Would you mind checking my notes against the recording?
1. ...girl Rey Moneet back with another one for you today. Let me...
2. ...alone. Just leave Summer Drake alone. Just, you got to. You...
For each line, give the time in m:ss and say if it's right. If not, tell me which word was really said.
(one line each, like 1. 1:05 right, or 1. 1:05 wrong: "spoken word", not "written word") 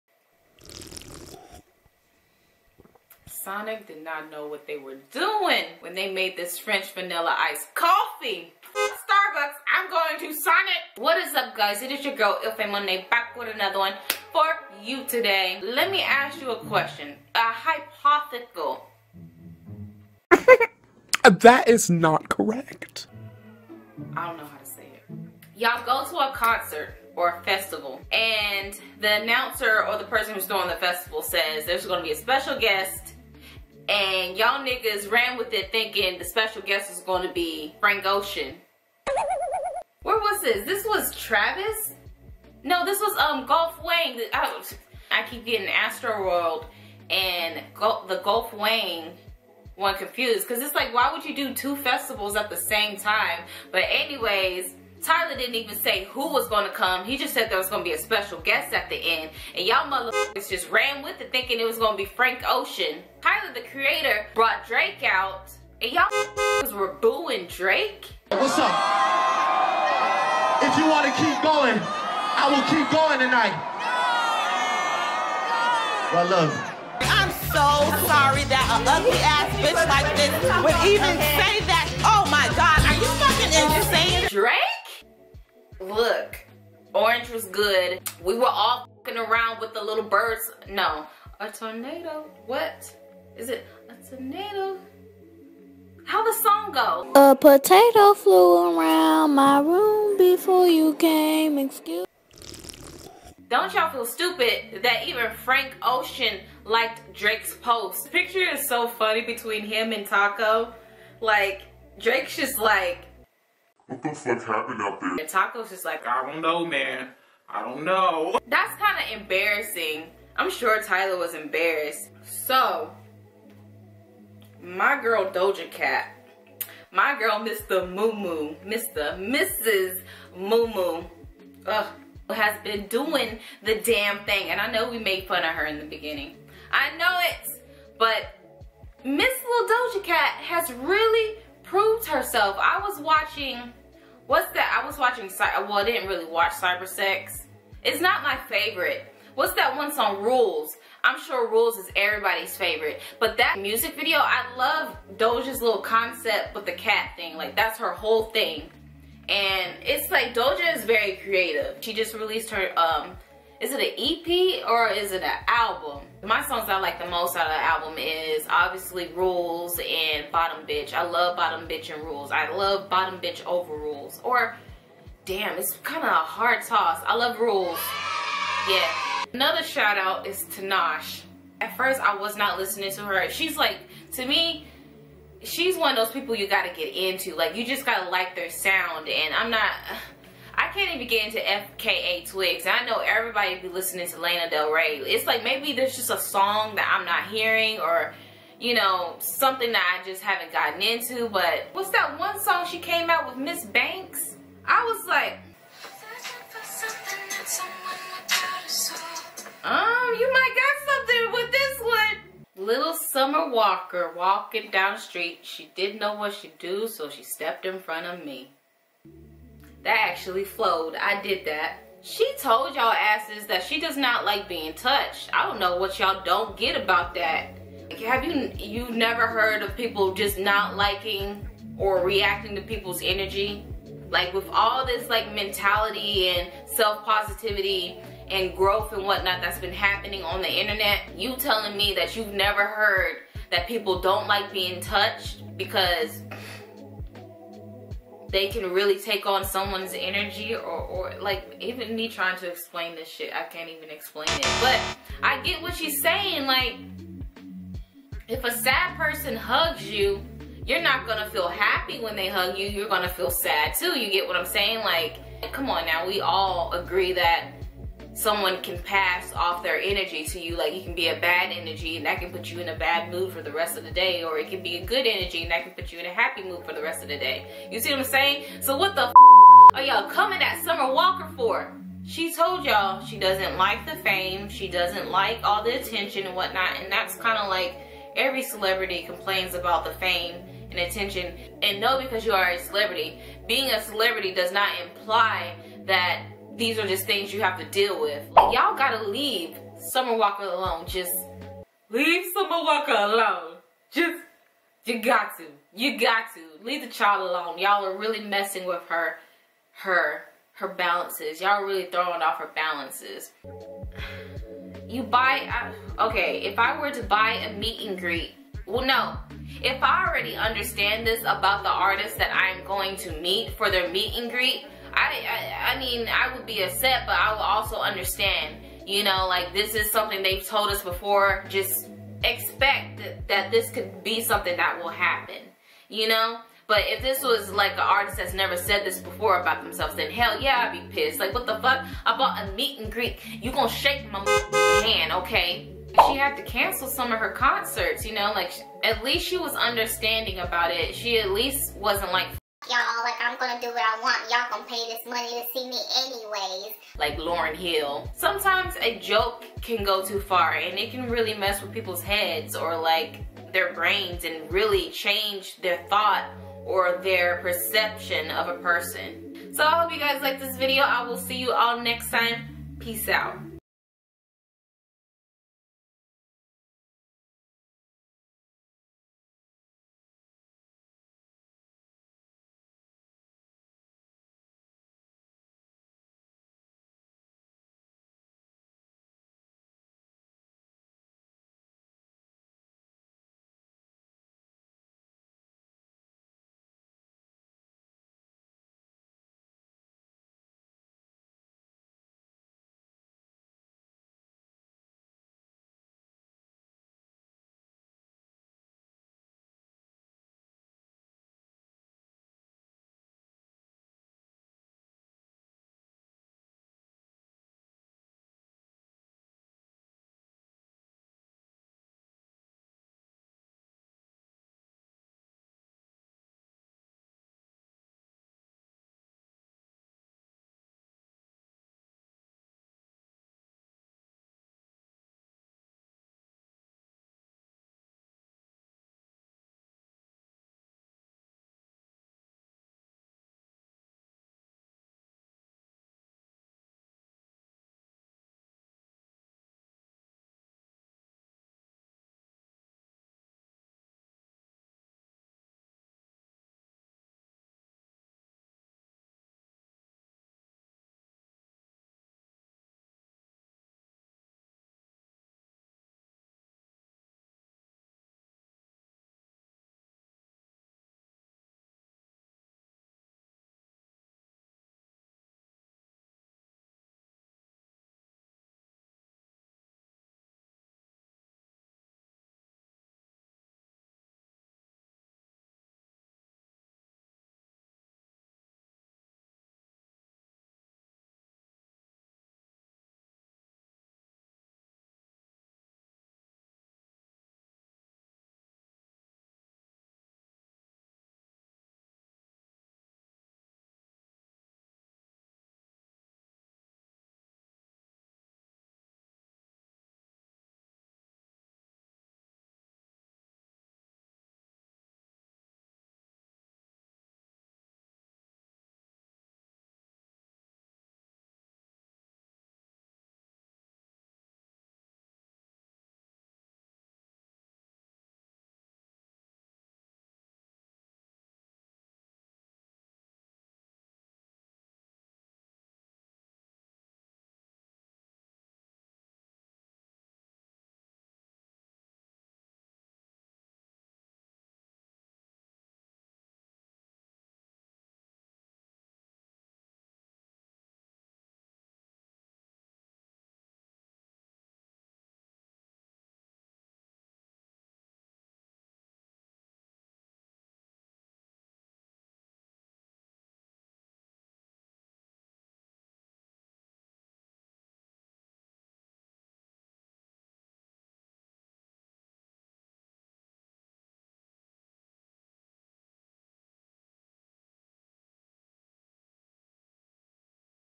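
1. 0:12 wrong: "Ilfae", not "Rey"
2. 5:00 wrong: "Walker", not "Drake".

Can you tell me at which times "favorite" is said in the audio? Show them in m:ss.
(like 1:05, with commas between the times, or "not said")
2:28, 2:32.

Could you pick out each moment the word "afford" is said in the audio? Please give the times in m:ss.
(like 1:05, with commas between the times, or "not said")
not said.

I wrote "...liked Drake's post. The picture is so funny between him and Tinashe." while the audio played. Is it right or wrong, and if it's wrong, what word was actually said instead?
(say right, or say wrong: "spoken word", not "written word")
wrong: "Taco", not "Tinashe".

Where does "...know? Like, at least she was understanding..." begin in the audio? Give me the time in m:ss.
5:48.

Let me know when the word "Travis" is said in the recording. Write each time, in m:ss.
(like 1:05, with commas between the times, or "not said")
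0:41.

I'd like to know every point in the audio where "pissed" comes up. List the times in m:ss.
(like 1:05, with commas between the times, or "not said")
5:40.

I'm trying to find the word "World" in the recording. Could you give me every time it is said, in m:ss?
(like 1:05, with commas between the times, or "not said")
0:46.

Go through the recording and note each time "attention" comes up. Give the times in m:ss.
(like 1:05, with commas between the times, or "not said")
4:45, 4:50.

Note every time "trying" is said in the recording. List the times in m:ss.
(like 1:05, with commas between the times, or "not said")
4:12.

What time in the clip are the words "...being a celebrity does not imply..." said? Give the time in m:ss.
4:53.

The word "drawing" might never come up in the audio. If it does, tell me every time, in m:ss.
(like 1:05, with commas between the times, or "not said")
not said.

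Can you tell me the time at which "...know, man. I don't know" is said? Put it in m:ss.
1:56.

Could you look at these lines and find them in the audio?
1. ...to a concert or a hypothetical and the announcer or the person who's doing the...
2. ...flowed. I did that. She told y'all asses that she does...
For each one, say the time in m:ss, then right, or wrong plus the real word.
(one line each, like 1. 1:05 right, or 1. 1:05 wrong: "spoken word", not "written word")
1. 0:26 wrong: "festival", not "hypothetical"
2. 3:40 right.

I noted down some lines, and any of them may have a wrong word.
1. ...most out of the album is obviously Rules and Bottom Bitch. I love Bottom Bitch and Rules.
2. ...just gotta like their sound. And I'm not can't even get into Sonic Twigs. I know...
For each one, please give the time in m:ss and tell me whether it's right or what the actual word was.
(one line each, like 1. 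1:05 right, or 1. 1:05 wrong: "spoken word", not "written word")
1. 2:47 right
2. 3:07 wrong: "FKA", not "Sonic".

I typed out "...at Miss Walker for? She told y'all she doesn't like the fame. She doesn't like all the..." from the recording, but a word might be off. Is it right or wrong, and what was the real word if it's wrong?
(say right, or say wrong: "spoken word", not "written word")
wrong: "Summer", not "Miss".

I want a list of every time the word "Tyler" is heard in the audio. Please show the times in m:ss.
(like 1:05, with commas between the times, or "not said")
0:55, 1:03, 2:00.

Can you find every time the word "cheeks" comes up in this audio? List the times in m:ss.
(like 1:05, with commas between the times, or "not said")
not said.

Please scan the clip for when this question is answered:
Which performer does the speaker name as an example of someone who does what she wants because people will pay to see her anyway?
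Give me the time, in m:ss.
5:57.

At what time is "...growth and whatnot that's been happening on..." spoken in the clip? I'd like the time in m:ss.
3:58.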